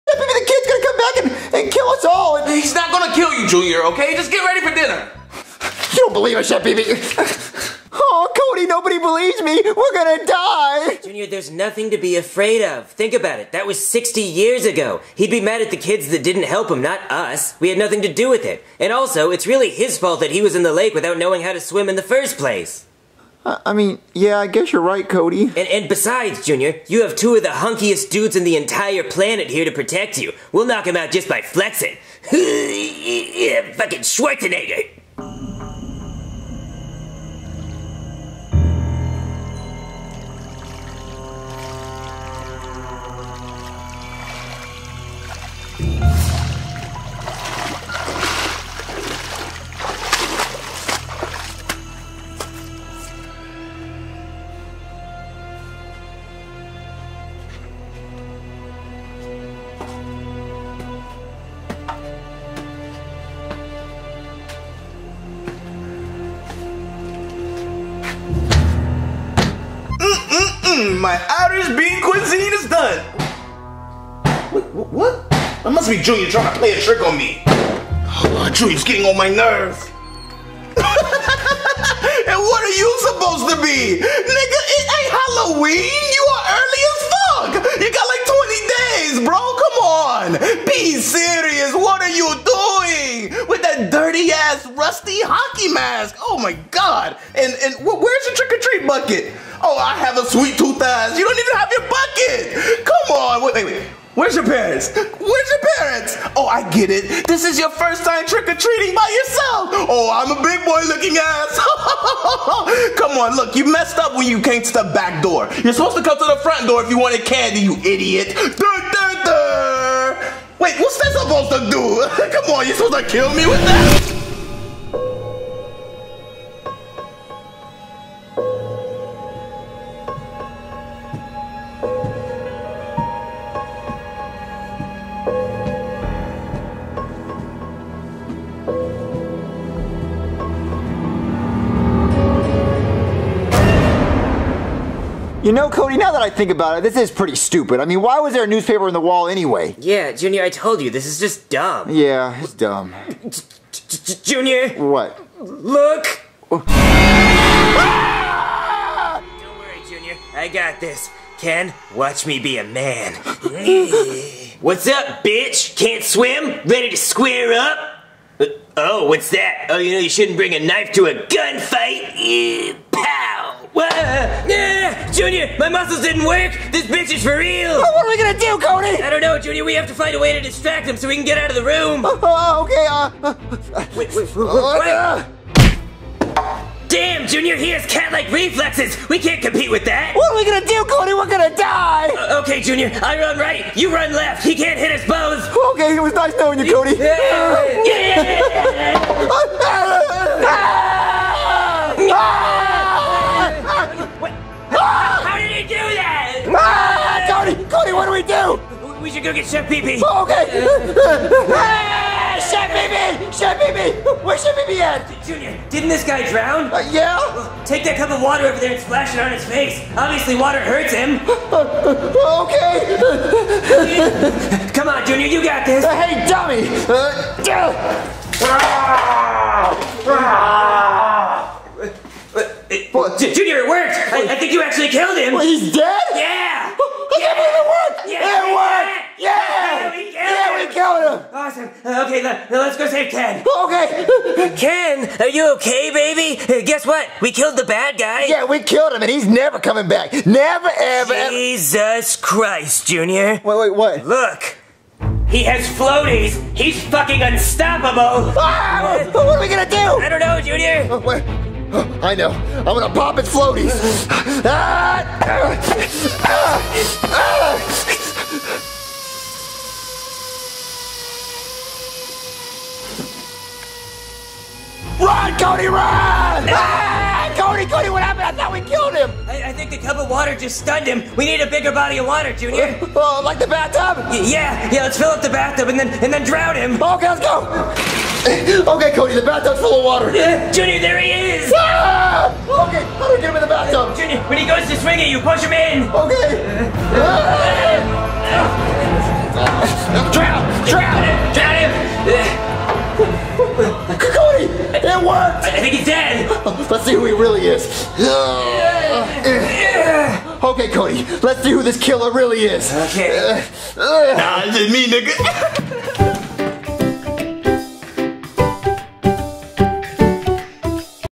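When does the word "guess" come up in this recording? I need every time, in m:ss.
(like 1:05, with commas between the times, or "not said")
0:24, 4:06.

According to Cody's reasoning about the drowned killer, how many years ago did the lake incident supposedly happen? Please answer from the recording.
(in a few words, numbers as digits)
60.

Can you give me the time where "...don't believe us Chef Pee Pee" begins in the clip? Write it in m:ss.
0:05.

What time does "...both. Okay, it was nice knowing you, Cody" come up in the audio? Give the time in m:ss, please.
3:15.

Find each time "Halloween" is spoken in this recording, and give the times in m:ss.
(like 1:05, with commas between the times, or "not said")
1:25.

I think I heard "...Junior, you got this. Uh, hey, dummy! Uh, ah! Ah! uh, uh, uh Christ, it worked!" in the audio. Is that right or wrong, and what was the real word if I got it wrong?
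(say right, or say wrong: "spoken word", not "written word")
wrong: "Junior", not "Christ".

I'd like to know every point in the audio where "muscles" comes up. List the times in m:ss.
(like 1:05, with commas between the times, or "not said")
2:55.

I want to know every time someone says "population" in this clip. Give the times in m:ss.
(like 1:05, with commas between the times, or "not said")
not said.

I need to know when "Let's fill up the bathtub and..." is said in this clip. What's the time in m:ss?
4:44.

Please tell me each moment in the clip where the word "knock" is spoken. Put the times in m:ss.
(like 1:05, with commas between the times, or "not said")
0:30.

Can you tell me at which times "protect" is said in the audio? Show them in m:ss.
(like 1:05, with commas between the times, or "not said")
0:29.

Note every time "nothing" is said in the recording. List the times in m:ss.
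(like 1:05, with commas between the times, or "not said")
0:11, 0:17.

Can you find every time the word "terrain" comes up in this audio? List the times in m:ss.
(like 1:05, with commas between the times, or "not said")
not said.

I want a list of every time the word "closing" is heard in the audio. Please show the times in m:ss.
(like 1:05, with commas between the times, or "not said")
not said.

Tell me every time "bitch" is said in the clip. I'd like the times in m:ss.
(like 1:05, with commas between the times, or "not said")
2:45, 2:56.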